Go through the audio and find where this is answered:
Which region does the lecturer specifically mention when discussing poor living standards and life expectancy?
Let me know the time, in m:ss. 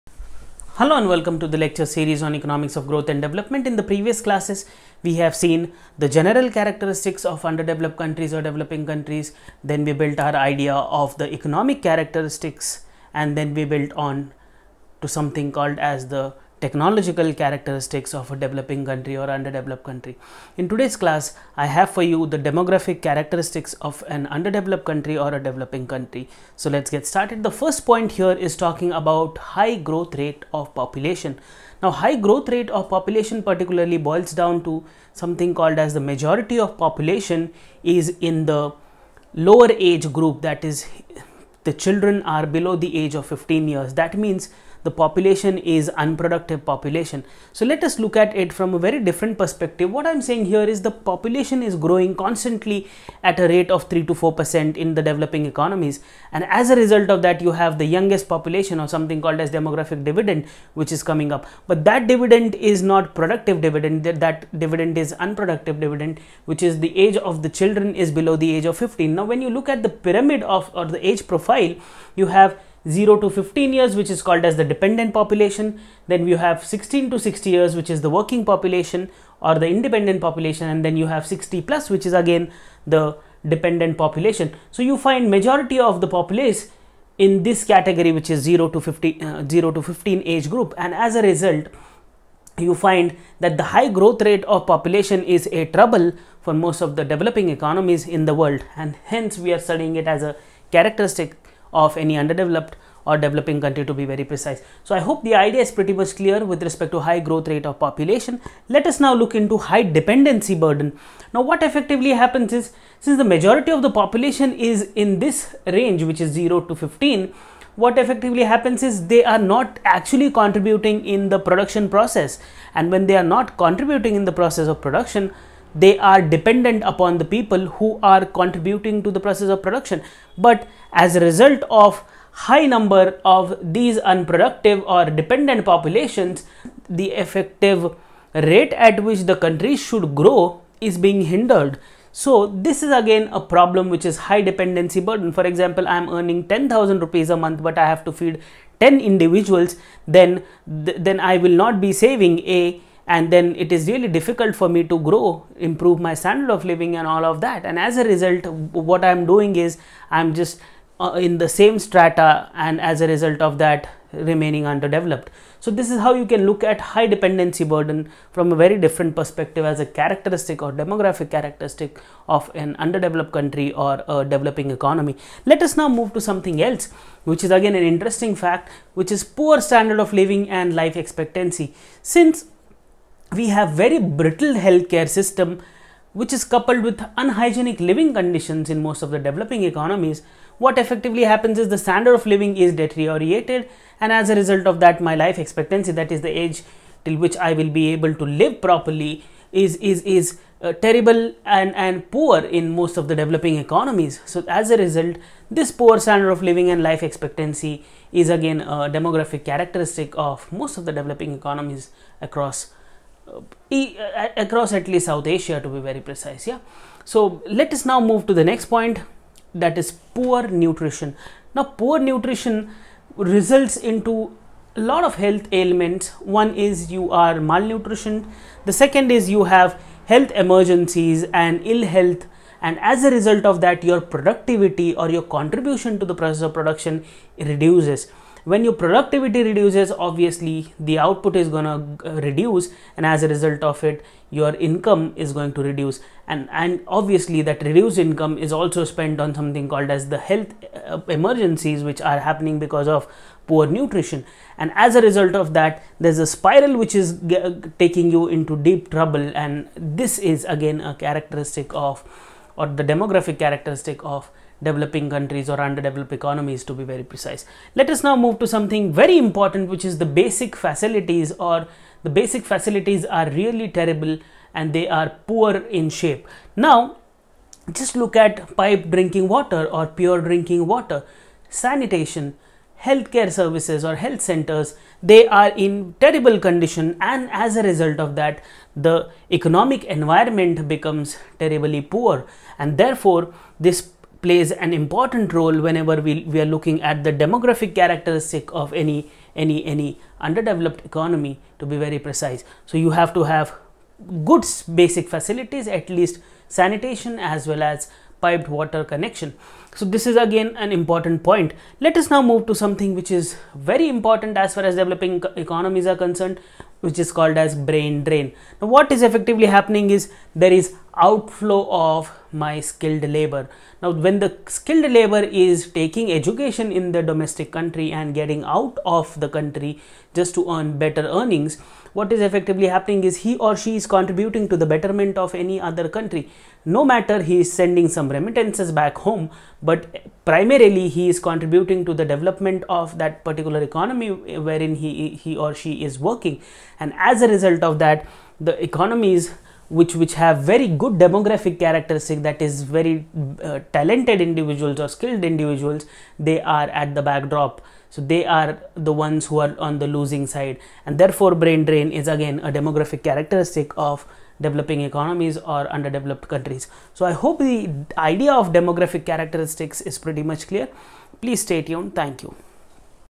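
3:35.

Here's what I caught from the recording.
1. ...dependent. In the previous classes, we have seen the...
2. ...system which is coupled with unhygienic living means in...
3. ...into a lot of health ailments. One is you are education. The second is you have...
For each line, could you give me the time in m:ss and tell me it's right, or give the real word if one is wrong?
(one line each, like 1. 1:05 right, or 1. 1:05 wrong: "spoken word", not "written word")
1. 0:03 wrong: "development", not "dependent"
2. 3:05 wrong: "conditions", not "means"
3. 3:43 wrong: "malnutrition", not "education".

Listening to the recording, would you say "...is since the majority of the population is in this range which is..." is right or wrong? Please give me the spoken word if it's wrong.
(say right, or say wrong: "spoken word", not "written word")
right.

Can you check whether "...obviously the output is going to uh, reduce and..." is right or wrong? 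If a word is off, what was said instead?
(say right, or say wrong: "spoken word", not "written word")
right.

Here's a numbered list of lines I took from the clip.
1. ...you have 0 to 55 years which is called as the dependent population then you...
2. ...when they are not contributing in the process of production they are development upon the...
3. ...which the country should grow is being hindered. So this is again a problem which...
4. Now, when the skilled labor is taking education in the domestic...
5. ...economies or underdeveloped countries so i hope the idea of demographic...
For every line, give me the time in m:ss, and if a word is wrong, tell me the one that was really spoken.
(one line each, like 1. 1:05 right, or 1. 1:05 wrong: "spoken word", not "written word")
1. 1:12 wrong: "15", not "55"
2. 2:02 wrong: "dependent", not "development"
3. 2:19 right
4. 5:23 right
5. 6:04 right.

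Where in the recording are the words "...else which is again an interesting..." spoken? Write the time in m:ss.
2:56.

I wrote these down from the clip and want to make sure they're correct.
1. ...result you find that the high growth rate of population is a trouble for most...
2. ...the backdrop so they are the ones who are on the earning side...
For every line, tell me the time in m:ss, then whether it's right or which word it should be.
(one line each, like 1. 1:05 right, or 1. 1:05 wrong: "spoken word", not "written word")
1. 1:31 right
2. 5:56 wrong: "losing", not "earning".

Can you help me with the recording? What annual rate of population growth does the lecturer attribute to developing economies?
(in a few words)
3 to 4%.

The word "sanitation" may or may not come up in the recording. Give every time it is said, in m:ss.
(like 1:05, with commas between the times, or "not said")
4:41, 5:06.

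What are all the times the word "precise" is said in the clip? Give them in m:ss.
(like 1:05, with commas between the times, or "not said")
1:44, 3:36, 4:27, 5:01.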